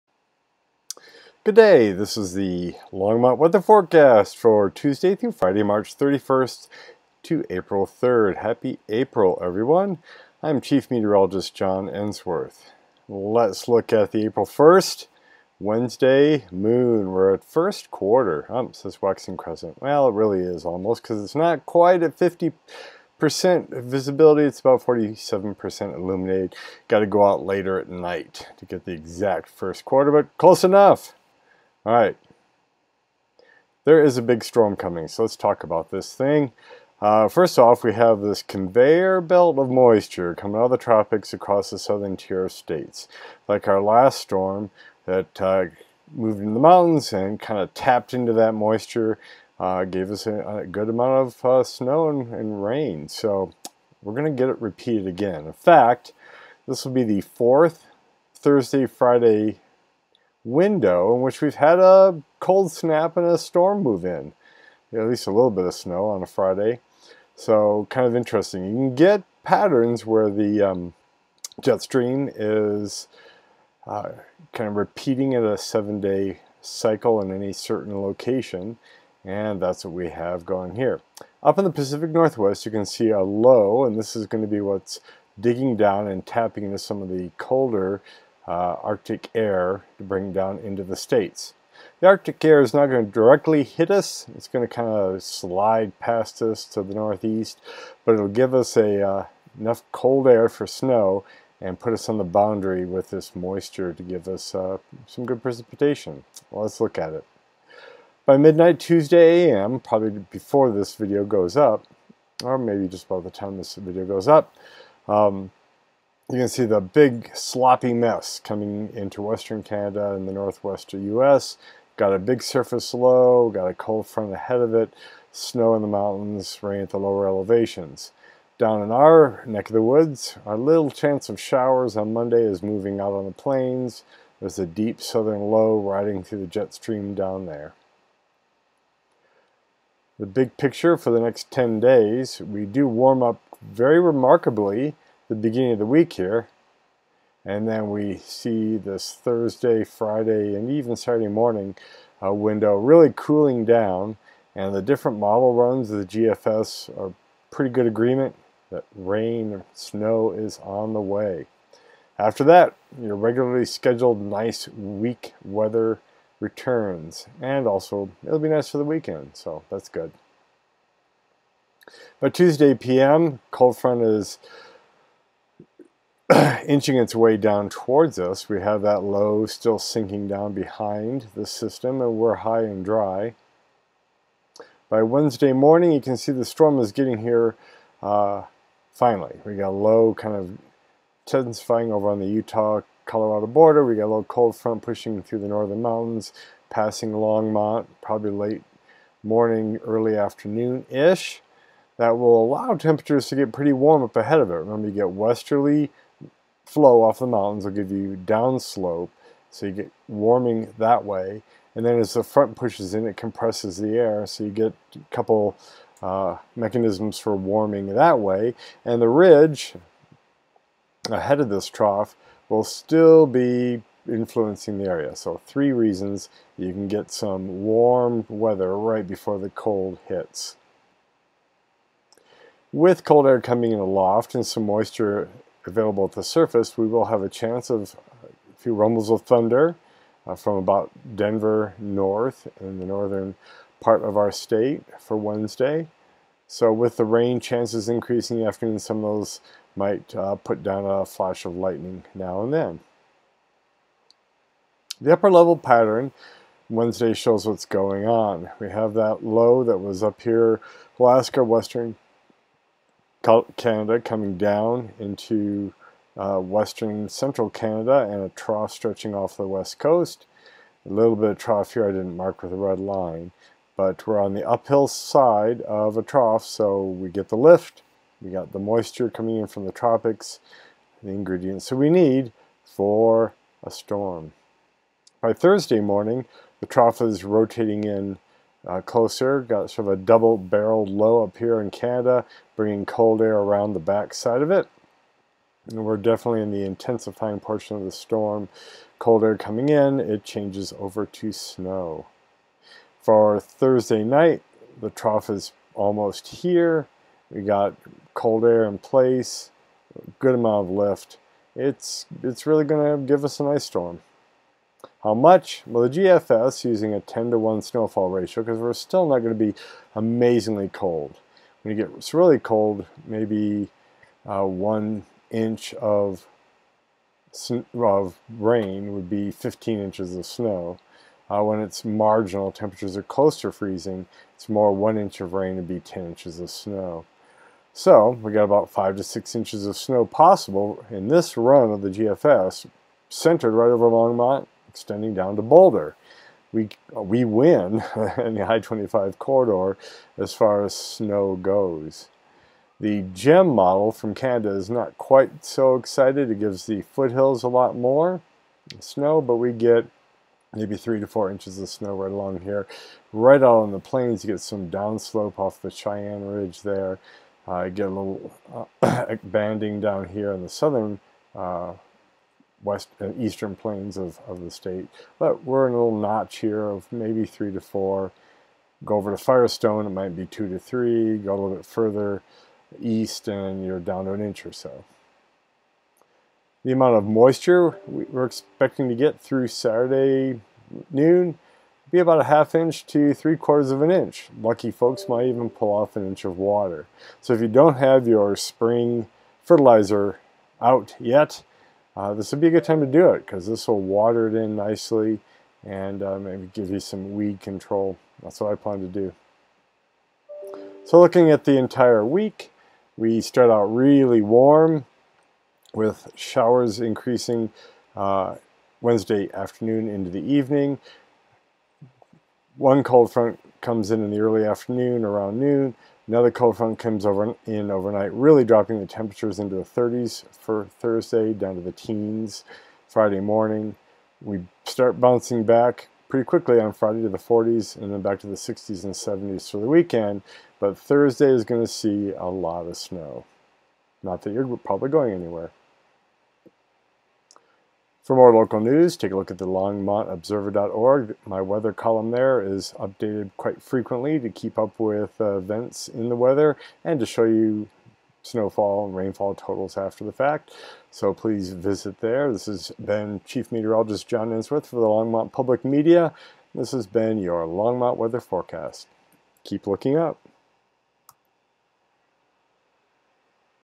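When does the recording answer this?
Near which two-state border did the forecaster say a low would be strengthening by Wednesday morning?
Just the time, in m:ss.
3:12.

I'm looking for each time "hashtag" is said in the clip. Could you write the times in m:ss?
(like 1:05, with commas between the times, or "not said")
not said.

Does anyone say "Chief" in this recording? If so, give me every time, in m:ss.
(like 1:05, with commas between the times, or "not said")
0:10, 7:43.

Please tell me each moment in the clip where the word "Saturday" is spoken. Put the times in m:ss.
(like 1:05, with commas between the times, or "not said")
2:30, 6:29.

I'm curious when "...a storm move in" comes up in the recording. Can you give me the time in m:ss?
1:03.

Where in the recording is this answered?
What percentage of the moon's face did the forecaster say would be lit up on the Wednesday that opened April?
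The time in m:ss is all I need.
0:24.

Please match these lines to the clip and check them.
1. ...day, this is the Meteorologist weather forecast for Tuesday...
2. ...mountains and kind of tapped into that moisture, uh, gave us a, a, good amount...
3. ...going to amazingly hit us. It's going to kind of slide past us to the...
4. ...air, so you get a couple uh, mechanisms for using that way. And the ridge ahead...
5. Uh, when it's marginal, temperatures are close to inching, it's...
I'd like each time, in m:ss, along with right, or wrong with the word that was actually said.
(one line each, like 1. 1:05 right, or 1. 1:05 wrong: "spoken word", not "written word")
1. 0:01 wrong: "Longmont", not "Meteorologist"
2. 0:46 right
3. 1:32 wrong: "directly", not "amazingly"
4. 3:33 wrong: "warming", not "using"
5. 5:31 wrong: "freezing", not "inching".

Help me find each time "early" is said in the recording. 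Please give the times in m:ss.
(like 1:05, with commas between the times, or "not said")
3:19, 7:04.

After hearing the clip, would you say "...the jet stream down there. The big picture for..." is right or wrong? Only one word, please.
right.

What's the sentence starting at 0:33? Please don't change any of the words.
There is a big storm coming, so let's talk about this thing.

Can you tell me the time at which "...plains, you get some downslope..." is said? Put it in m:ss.
6:03.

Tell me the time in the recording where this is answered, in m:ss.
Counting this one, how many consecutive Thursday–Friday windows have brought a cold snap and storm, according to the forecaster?
0:57.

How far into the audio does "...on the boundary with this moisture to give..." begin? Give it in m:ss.
1:42.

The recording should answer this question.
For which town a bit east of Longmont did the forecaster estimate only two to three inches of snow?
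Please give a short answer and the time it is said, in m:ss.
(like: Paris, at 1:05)
Firestone, at 6:19.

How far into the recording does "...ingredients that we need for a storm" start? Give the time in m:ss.
4:41.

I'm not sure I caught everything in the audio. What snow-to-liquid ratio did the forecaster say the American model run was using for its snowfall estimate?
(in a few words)
10 to 1.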